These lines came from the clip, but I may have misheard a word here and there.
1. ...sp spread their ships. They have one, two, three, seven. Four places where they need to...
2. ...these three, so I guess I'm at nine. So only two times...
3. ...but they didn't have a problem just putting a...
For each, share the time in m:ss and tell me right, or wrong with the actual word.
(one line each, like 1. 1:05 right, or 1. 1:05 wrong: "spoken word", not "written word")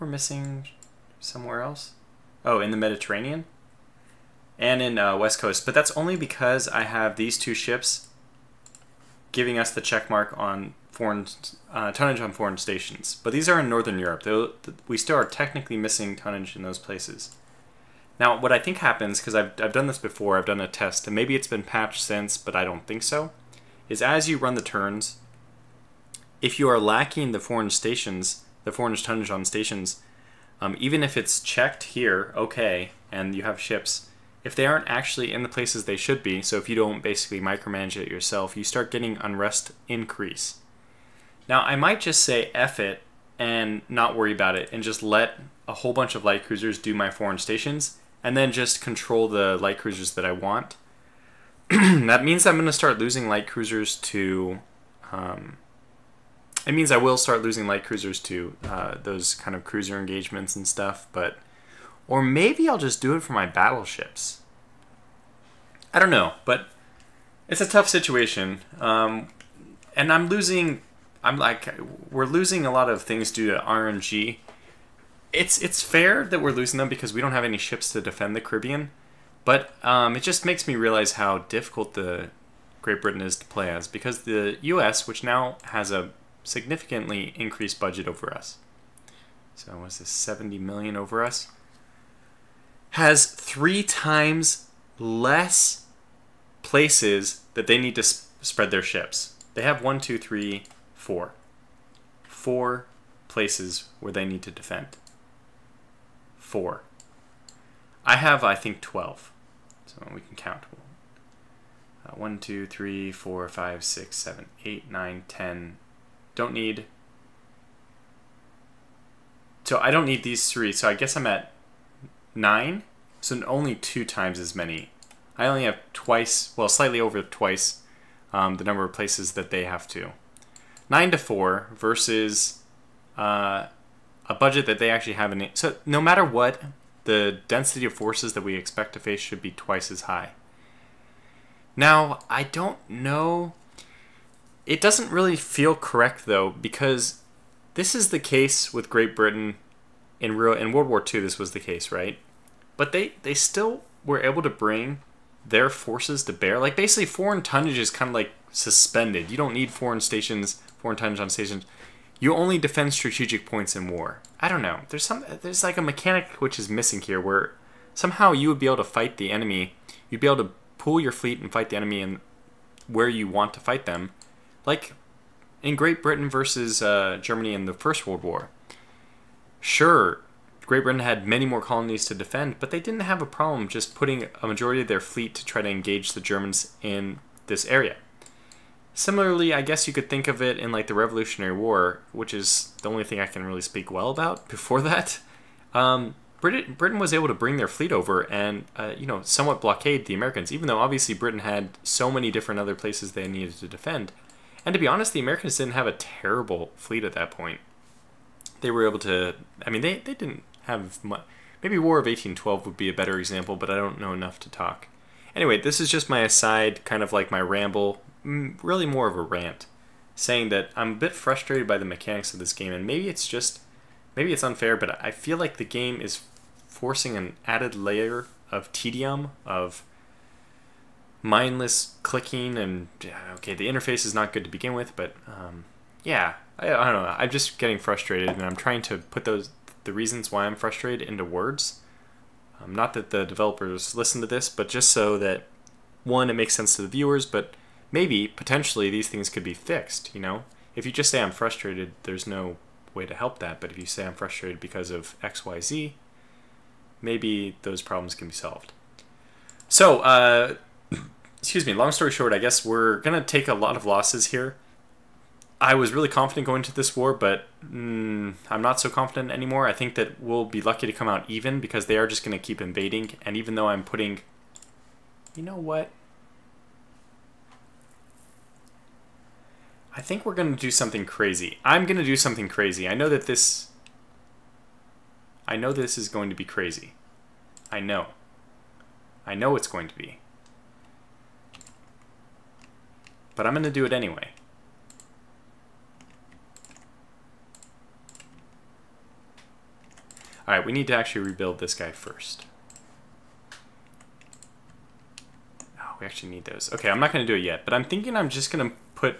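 1. 1:38 wrong: "four", not "seven"
2. 2:00 right
3. 3:02 right.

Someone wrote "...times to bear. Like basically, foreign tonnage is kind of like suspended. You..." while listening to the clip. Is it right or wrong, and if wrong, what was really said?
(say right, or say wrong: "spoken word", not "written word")
wrong: "forces", not "times".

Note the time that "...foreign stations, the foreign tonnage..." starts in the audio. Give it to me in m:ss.
0:27.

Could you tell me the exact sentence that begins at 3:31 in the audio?
Maybe War of 1812 would be a better example, but I don't know enough to talk.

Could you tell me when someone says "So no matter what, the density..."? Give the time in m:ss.
2:15.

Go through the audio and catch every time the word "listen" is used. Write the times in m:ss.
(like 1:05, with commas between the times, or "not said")
4:03.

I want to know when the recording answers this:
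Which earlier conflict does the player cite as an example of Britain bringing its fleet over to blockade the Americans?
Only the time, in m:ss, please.
3:10.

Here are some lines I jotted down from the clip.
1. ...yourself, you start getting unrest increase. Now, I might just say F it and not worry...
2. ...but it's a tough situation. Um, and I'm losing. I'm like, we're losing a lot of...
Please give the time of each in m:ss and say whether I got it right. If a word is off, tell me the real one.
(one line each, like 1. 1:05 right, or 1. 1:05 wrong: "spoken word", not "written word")
1. 0:38 right
2. 1:06 right.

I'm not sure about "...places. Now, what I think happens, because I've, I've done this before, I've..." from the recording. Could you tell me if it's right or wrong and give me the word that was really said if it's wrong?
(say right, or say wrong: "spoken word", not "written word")
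right.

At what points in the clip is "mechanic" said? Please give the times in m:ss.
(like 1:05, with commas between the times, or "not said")
2:45, 3:41.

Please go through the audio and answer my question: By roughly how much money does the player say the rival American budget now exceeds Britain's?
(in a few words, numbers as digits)
70 million.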